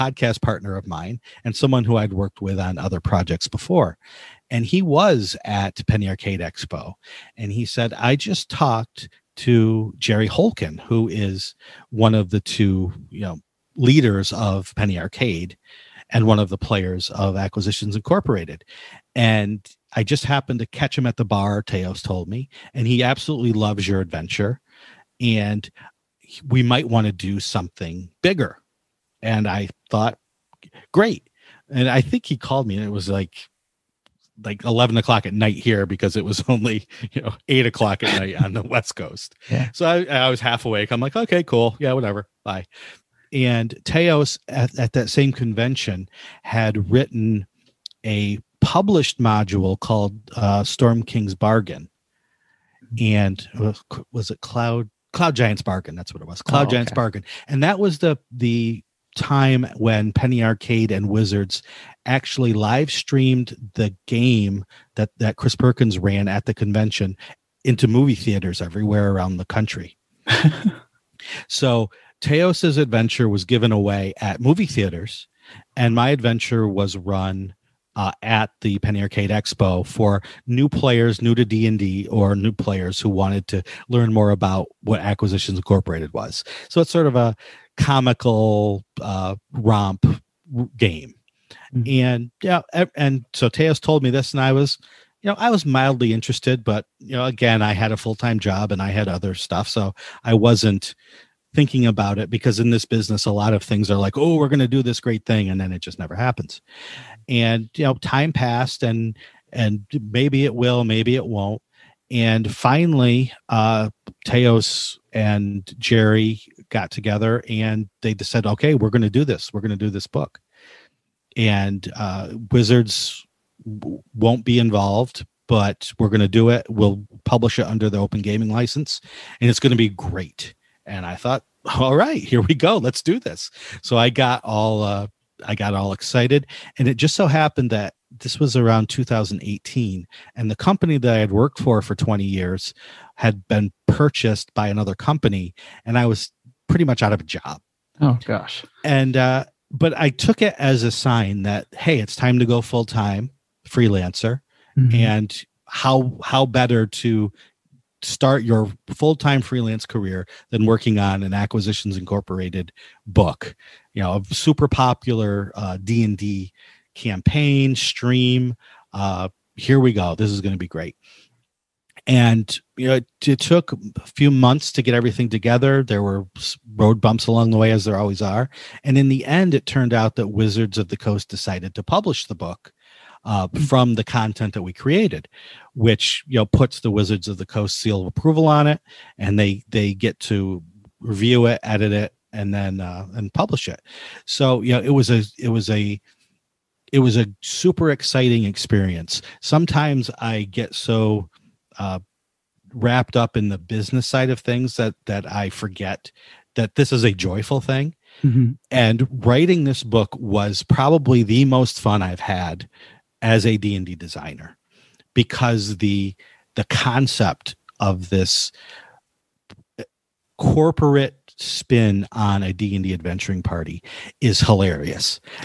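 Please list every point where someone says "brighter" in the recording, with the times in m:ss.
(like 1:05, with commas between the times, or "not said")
not said.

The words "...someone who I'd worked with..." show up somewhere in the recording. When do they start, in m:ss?
0:01.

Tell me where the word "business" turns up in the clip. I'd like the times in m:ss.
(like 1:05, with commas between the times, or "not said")
1:42, 3:23.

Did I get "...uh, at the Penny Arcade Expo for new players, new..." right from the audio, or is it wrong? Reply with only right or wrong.
right.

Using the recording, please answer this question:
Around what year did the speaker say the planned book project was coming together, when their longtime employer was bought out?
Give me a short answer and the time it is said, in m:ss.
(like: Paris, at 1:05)
2018, at 2:18.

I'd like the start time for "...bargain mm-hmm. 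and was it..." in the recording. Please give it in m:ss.
0:51.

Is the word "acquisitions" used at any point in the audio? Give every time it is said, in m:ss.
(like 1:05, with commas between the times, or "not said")
0:17, 1:24, 2:41.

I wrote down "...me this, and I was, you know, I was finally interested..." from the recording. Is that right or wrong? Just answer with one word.
wrong.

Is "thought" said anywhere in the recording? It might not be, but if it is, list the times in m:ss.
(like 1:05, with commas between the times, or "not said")
0:29, 2:11.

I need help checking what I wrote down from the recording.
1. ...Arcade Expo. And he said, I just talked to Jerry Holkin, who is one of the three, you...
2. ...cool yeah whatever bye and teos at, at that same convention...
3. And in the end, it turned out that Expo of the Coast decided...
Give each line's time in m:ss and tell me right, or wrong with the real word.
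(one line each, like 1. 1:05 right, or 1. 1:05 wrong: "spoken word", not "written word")
1. 0:06 wrong: "two", not "three"
2. 0:41 right
3. 2:58 wrong: "Wizards", not "Expo".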